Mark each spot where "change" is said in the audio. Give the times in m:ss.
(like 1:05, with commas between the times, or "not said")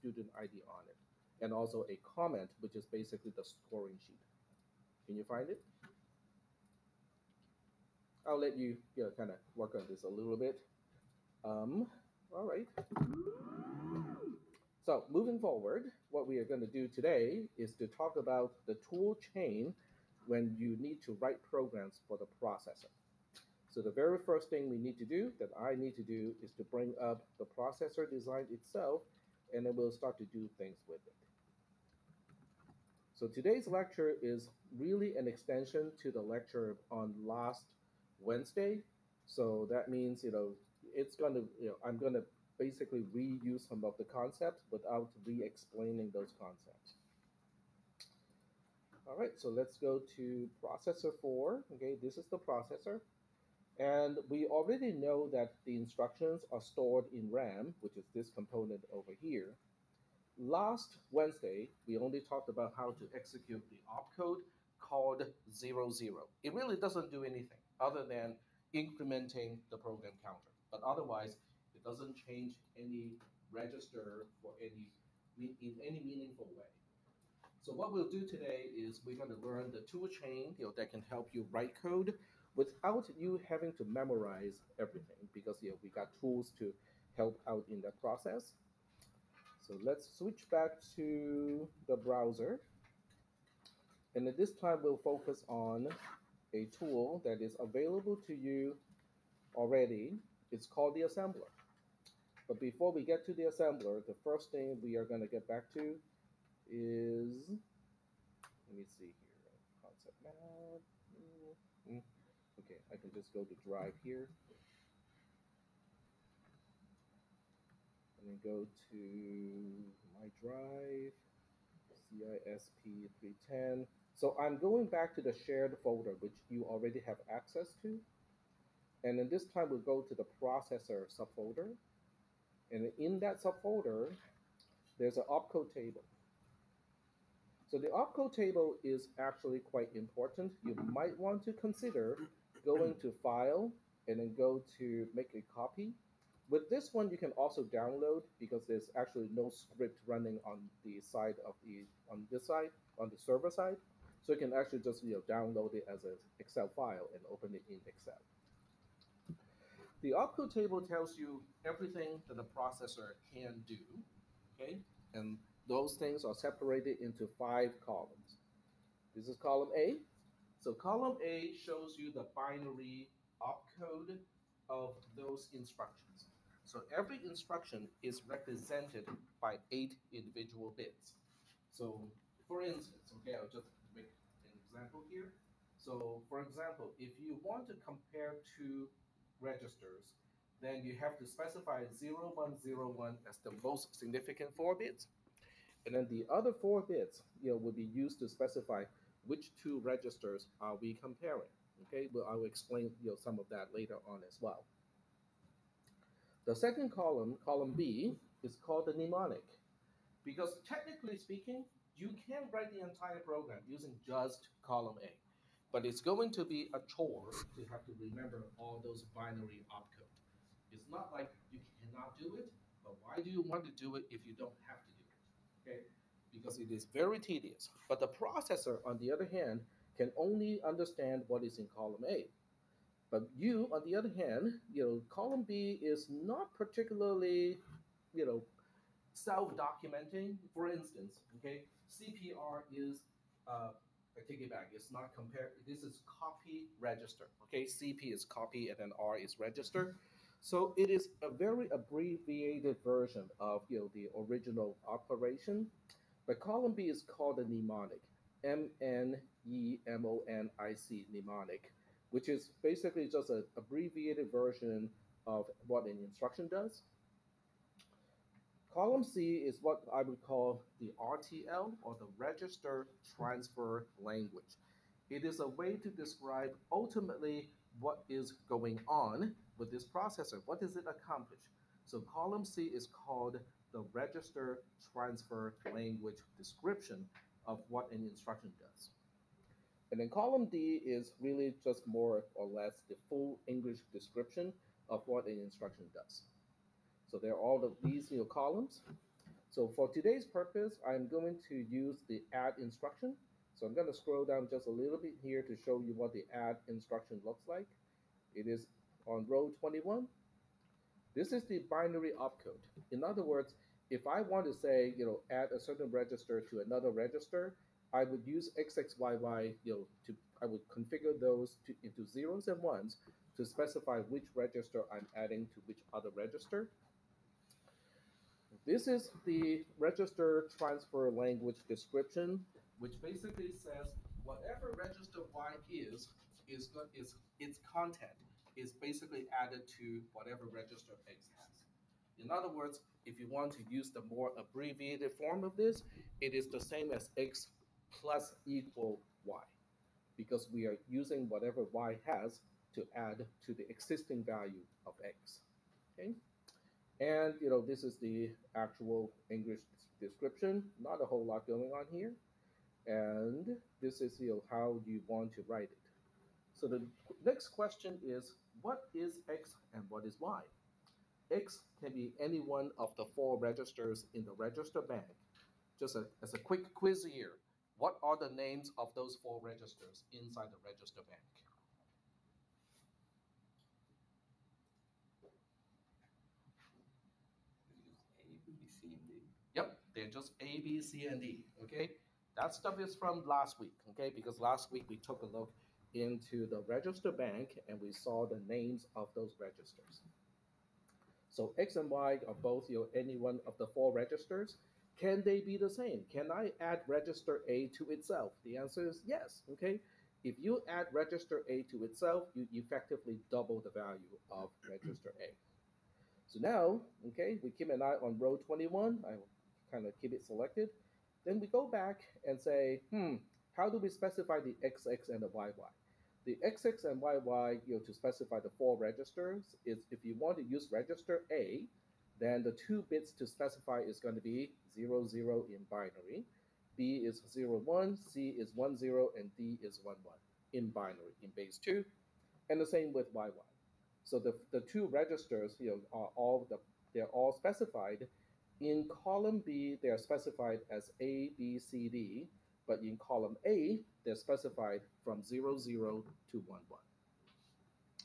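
1:12.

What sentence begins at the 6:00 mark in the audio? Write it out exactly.
Not a whole lot going on here.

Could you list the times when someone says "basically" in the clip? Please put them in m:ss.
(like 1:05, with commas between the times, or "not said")
0:02, 0:42, 4:22, 5:33, 5:38.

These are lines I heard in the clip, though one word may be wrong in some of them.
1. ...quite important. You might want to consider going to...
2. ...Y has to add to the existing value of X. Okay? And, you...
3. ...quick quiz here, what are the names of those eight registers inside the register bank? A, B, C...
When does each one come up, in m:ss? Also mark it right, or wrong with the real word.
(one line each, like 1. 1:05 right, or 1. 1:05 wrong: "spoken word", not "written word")
1. 2:19 right
2. 5:51 right
3. 6:16 wrong: "four", not "eight".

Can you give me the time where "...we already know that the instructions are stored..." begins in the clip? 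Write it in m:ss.
0:54.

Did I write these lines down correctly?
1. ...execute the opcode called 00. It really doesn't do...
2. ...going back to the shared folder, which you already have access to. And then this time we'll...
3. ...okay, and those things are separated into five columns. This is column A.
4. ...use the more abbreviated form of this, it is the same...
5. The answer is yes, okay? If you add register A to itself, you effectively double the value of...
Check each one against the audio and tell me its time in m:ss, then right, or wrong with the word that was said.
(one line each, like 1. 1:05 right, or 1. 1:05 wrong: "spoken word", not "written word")
1. 1:03 right
2. 2:04 right
3. 2:44 right
4. 5:43 right
5. 6:48 right.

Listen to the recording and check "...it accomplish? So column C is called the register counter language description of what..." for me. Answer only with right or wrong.
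wrong.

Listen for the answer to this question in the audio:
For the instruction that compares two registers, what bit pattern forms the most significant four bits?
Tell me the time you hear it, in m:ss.
3:11.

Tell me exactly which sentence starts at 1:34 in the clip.
And at this time, we'll focus on a tool that is available to you already.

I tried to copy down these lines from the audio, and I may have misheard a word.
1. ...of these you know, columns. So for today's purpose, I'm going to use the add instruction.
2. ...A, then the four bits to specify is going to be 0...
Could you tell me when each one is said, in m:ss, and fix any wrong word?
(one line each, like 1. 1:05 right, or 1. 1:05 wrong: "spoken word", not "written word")
1. 4:57 right
2. 7:11 wrong: "two", not "four".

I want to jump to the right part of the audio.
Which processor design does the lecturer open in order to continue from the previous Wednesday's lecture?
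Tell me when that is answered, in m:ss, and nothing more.
0:50.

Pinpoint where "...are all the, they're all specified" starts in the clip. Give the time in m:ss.
7:25.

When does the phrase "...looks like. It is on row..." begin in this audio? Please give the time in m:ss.
5:07.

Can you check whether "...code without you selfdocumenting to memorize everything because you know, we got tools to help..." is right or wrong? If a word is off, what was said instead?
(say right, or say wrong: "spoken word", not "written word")
wrong: "having", not "selfdocumenting".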